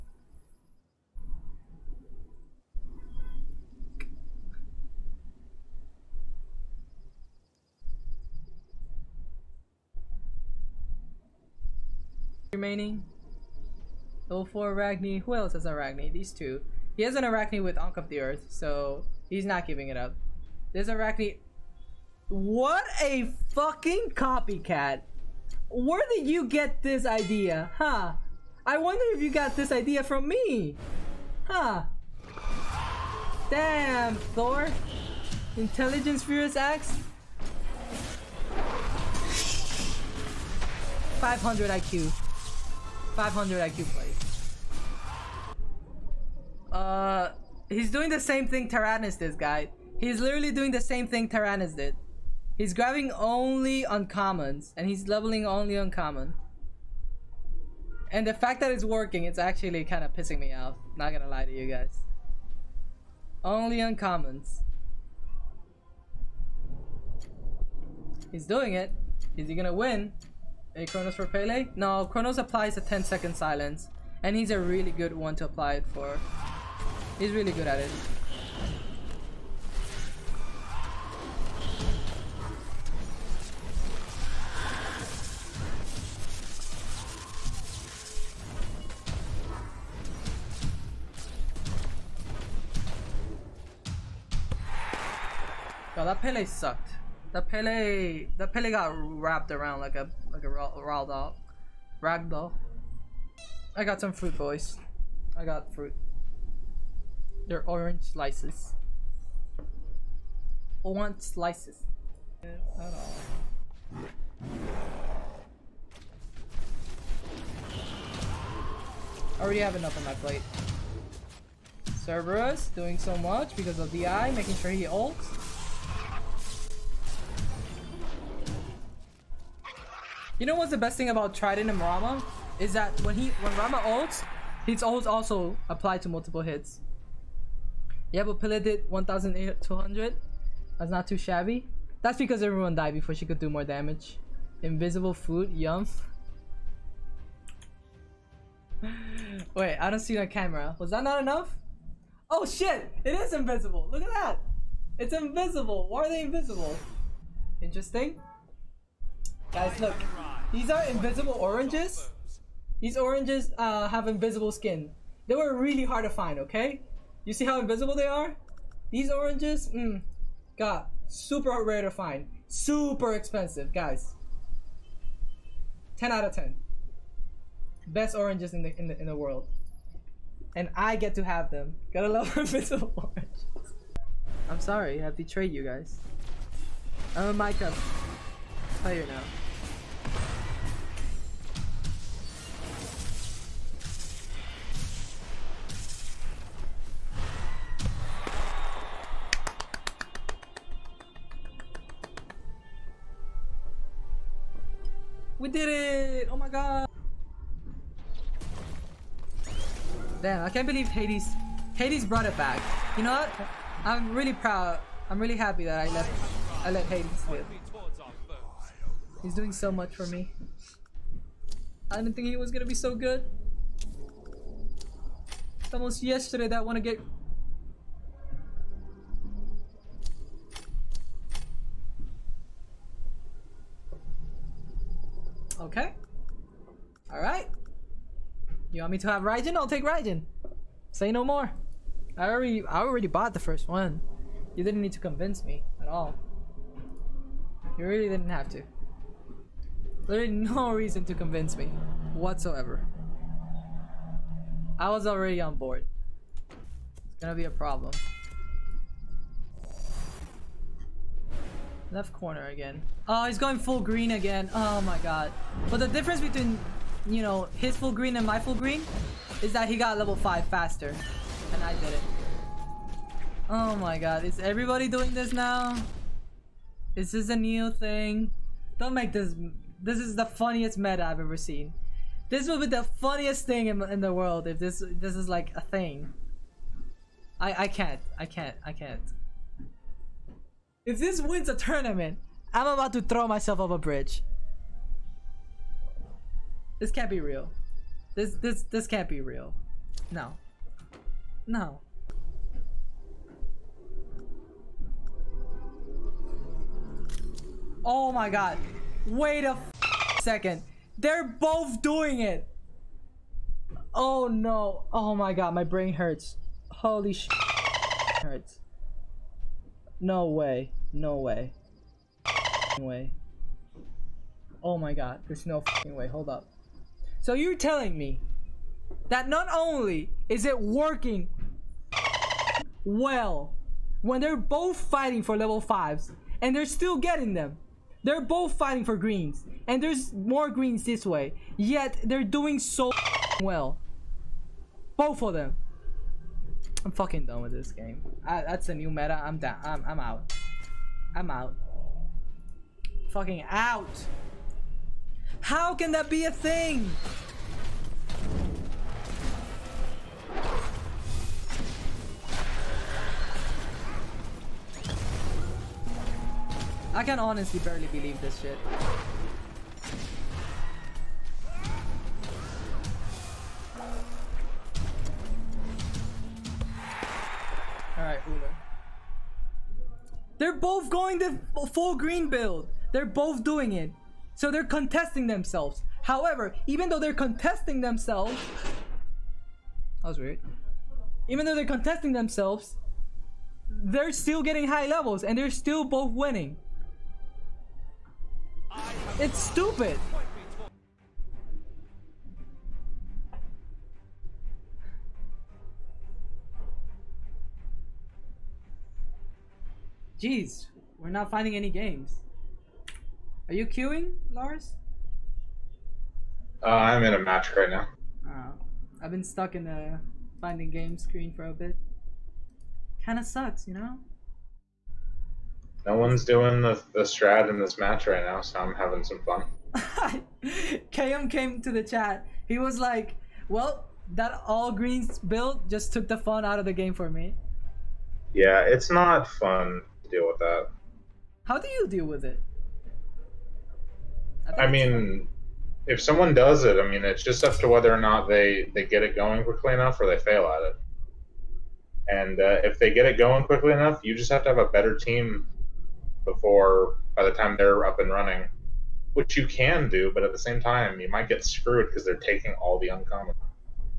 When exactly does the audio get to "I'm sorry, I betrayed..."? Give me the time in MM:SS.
03:04.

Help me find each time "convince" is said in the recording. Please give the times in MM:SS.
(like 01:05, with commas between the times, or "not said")
04:04, 04:11.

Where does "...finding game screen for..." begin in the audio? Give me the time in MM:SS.
07:00.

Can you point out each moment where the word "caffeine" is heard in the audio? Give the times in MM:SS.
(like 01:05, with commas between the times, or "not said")
not said.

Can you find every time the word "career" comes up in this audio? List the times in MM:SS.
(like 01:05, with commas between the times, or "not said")
not said.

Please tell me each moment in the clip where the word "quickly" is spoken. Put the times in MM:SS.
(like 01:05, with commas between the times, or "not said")
07:29, 07:33.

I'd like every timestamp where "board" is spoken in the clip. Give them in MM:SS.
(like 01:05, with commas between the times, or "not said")
04:15.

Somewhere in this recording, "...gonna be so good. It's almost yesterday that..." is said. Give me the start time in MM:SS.
03:42.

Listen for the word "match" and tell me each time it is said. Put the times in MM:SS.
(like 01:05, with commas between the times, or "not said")
06:57, 07:07.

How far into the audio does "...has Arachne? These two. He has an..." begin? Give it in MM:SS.
00:15.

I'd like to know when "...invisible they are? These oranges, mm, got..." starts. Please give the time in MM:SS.
02:47.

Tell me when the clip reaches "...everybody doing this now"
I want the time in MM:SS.
04:34.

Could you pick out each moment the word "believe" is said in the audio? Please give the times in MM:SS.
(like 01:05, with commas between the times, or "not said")
03:30, 06:07.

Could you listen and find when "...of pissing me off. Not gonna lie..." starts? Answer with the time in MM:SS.
01:00.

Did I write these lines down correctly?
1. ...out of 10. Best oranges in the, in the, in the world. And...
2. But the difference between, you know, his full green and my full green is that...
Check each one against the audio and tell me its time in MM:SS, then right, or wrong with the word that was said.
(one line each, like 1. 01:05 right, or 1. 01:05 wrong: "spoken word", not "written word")
1. 02:56 right
2. 04:25 right.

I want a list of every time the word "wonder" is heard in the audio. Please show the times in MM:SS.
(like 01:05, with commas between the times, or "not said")
00:28.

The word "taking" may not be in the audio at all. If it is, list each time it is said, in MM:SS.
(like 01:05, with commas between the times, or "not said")
07:42.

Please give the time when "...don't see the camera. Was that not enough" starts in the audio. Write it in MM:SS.
02:29.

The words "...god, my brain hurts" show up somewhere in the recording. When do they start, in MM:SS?
05:15.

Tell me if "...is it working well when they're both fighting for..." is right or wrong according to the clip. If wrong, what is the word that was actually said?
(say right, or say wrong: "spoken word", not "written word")
right.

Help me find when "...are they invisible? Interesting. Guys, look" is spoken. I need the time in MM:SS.
02:36.